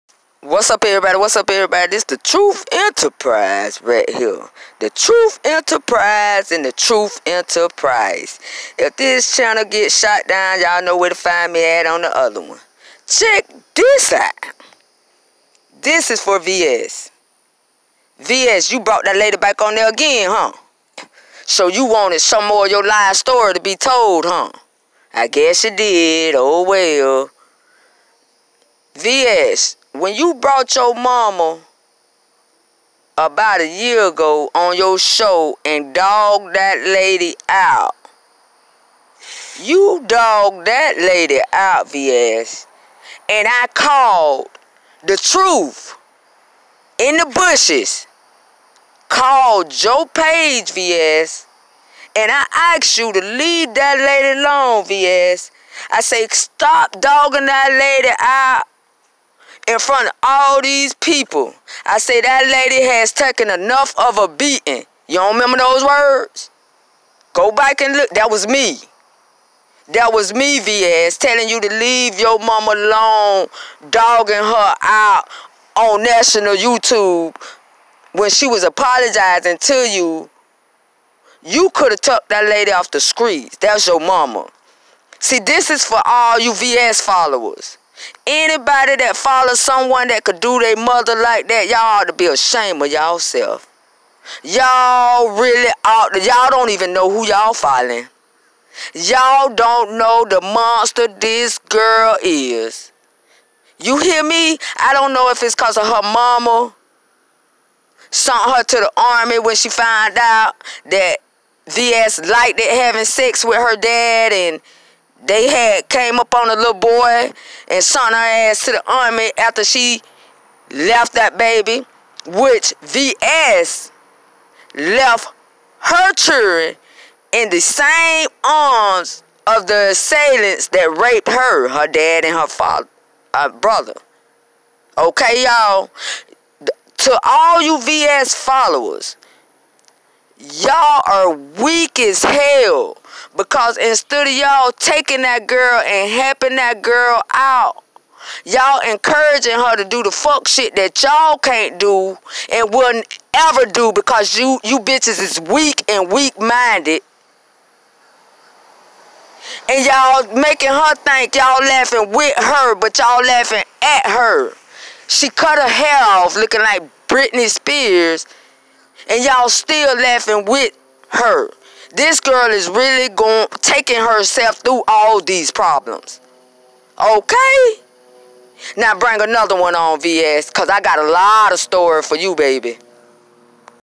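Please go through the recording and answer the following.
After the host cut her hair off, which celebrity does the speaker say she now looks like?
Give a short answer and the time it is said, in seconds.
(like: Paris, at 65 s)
Britney Spears, at 167 s.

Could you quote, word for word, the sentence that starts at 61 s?
I say that lady has taken enough of a beating.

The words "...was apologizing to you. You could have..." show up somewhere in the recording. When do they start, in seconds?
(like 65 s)
78 s.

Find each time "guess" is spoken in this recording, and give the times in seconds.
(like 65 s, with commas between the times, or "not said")
25 s.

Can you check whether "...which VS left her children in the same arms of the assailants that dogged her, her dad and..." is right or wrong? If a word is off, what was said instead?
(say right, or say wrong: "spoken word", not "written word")
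wrong: "raped", not "dogged".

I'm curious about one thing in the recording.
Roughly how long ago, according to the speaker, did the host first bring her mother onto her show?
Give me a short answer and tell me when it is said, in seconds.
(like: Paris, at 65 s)
About a year, at 33 s.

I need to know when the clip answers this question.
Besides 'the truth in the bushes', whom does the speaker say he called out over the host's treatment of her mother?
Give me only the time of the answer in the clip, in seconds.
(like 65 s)
49 s.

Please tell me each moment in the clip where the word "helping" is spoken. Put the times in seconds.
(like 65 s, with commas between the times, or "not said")
146 s.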